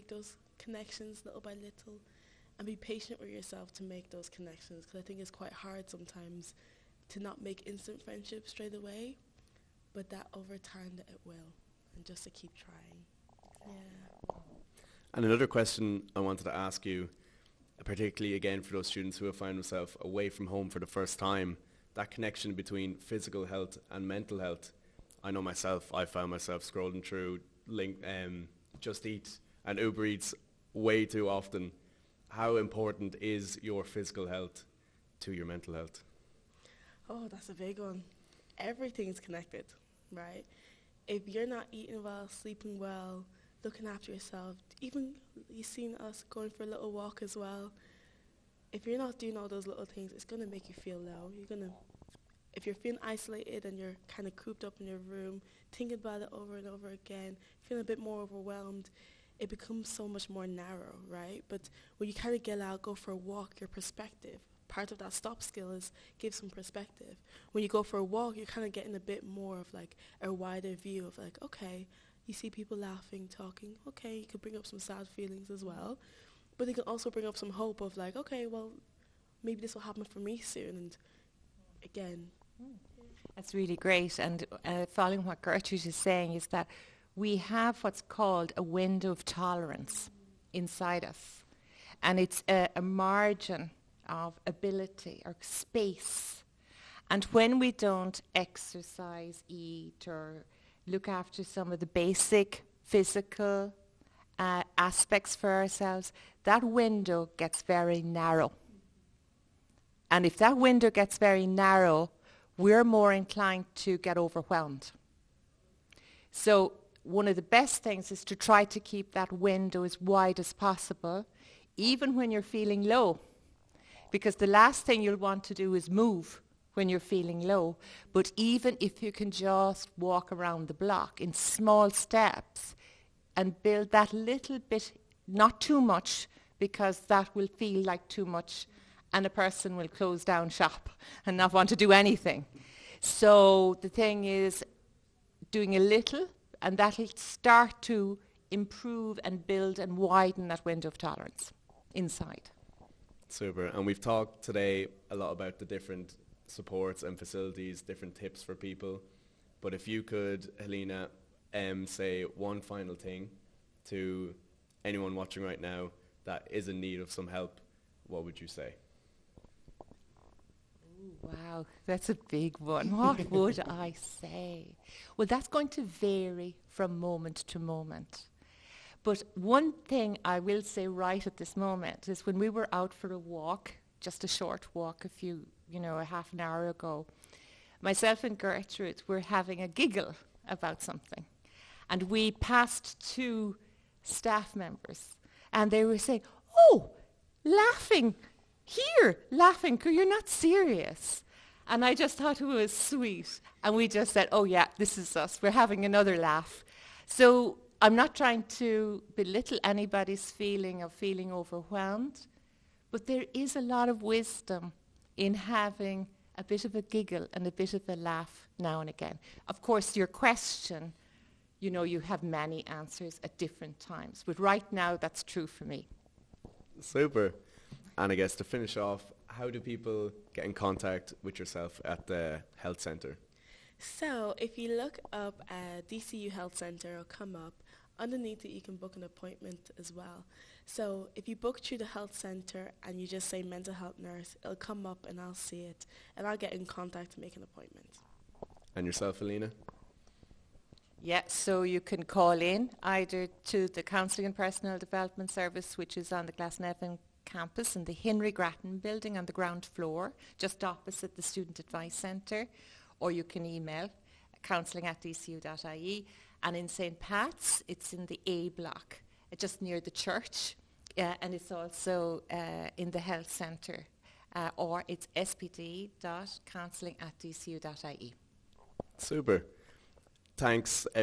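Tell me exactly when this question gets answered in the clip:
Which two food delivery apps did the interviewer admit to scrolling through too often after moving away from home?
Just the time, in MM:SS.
00:28.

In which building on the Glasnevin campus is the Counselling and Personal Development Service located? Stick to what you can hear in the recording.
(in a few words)
Henry Grattan building.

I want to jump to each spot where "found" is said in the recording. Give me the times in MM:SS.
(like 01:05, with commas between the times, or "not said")
00:19, 00:26.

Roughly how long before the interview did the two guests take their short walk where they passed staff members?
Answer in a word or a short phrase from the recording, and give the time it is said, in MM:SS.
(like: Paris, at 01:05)
Half an hour, at 03:05.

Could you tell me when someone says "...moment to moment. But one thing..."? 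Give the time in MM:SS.
02:56.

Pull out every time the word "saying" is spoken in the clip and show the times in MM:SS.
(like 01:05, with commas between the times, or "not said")
01:25, 03:15.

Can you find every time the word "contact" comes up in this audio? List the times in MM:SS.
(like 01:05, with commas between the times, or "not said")
03:50, 04:06.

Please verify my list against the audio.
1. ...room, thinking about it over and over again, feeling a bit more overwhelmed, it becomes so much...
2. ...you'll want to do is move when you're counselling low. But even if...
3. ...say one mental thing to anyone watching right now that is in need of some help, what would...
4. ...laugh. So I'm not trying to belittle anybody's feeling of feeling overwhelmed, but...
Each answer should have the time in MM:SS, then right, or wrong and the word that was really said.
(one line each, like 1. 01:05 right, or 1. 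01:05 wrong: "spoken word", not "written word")
1. 00:54 right
2. 02:05 wrong: "feeling", not "counselling"
3. 02:41 wrong: "final", not "mental"
4. 03:26 right.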